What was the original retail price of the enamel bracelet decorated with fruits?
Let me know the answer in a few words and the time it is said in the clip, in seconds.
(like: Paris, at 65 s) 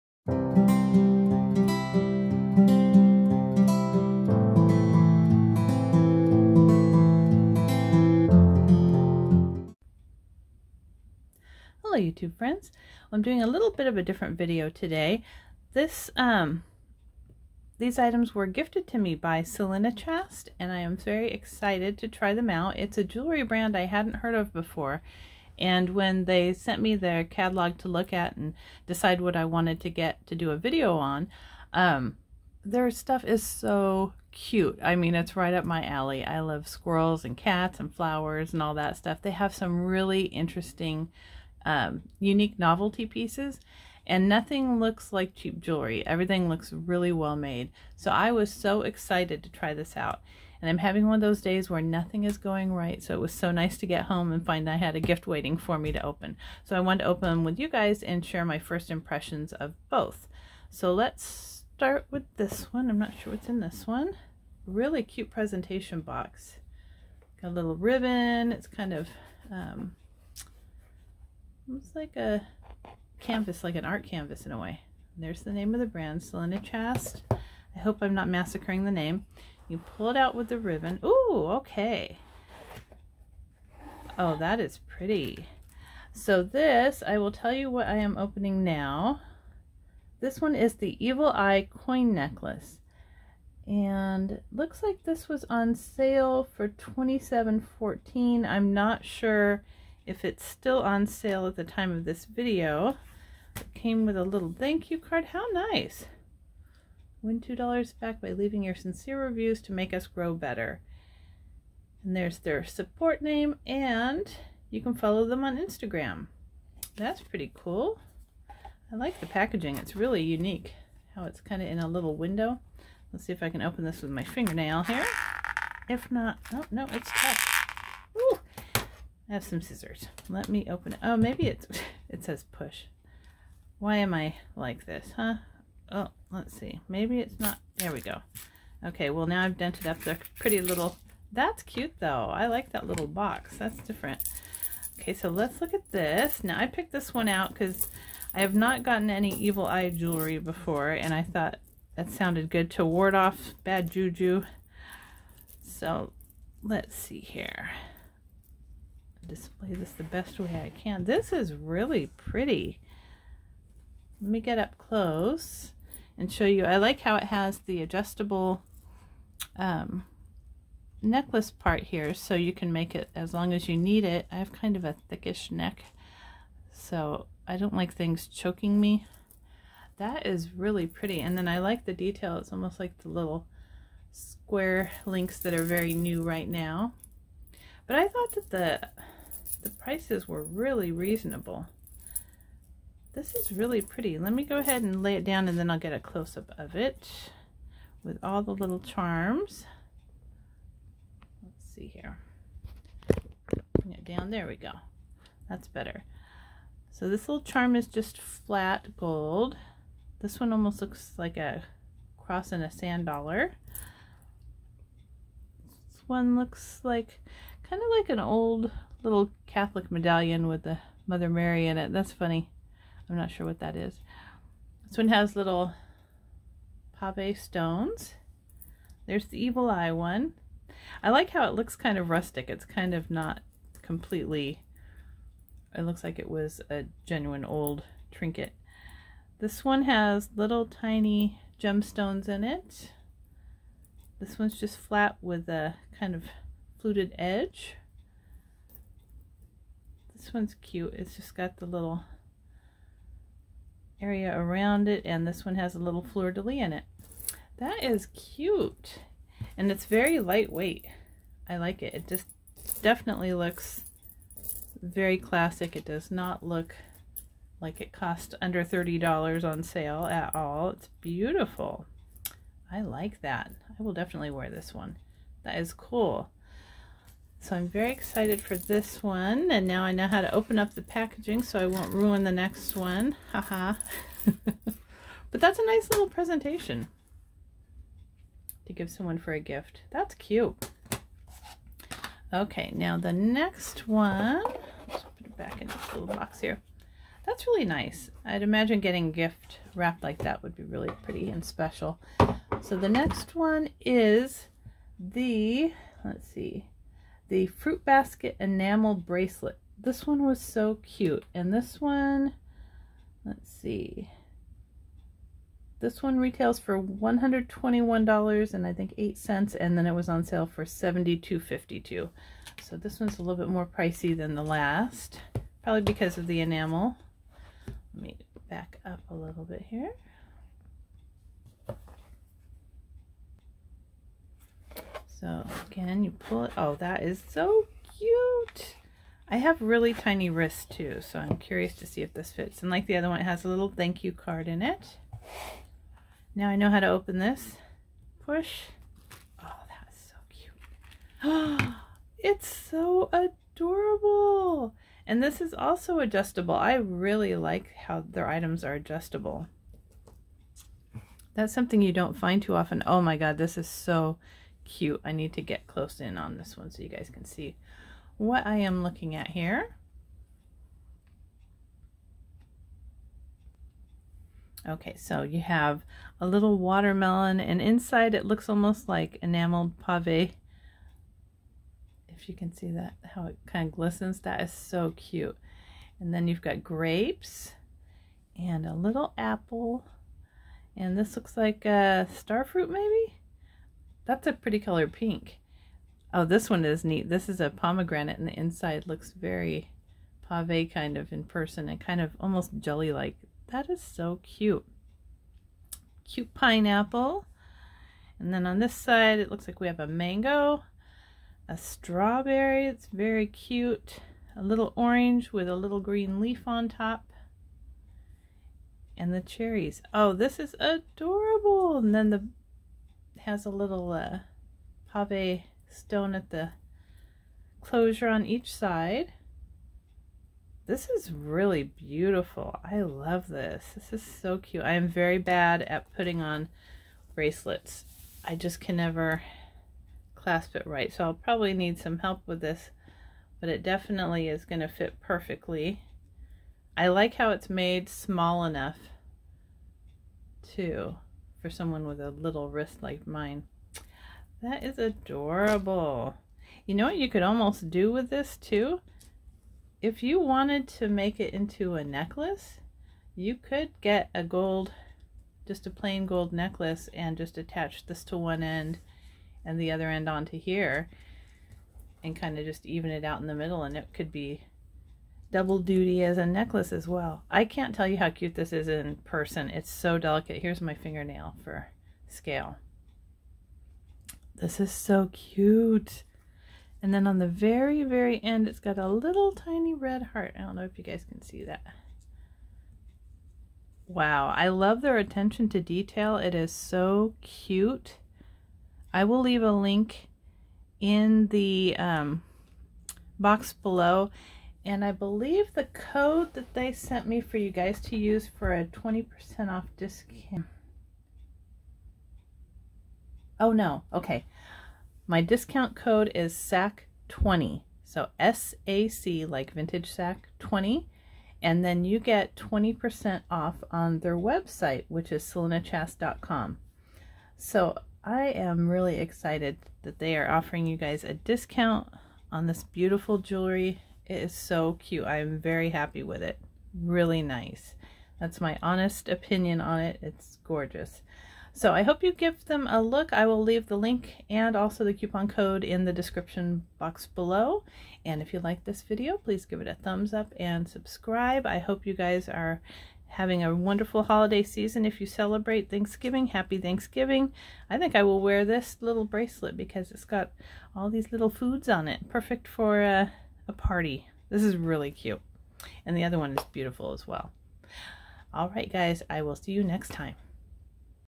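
$121.08, at 316 s.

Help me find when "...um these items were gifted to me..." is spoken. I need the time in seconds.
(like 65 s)
16 s.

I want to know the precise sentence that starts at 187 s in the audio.
But I thought that the the prices were really reasonable.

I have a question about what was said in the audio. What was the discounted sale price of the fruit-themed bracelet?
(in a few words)
$72.52.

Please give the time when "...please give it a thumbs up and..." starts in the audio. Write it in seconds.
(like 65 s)
549 s.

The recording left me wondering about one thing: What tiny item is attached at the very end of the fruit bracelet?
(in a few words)
red heart.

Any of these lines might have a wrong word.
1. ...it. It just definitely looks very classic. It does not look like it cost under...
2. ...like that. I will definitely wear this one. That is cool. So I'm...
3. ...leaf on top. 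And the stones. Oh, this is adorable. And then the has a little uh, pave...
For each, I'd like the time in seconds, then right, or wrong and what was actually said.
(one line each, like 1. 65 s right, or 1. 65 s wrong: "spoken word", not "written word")
1. 261 s right
2. 272 s right
3. 416 s wrong: "cherries", not "stones".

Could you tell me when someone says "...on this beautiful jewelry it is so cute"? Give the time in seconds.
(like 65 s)
532 s.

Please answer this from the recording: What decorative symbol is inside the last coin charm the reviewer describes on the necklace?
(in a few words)
fleur-de-lis.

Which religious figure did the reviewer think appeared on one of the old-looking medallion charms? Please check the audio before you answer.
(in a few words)
Mother Mary.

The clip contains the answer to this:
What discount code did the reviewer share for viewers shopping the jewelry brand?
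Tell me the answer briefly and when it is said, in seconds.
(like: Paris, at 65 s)
SAC20, at 516 s.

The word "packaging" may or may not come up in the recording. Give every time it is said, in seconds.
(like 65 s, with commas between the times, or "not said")
119 s, 280 s.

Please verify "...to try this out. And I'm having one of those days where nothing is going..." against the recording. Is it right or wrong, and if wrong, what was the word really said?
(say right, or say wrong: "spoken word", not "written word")
right.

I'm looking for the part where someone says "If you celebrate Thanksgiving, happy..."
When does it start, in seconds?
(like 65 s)
554 s.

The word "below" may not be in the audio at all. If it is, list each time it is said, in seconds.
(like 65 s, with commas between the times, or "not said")
503 s, 547 s.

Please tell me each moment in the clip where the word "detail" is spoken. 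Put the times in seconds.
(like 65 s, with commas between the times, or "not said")
181 s, 495 s.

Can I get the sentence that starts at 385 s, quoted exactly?
And then you've got grapes and a little apple.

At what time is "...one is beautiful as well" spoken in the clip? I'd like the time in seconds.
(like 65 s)
566 s.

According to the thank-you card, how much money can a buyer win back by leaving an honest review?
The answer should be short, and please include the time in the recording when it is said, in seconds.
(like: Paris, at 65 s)
$2, at 107 s.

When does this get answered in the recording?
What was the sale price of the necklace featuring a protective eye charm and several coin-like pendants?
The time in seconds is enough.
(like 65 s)
96 s.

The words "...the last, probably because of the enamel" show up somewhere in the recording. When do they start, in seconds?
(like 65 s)
324 s.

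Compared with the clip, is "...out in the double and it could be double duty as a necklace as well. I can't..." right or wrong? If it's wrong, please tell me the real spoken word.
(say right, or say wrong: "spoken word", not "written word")
wrong: "middle", not "double".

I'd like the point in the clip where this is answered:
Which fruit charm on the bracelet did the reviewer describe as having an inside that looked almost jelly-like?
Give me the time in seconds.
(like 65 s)
397 s.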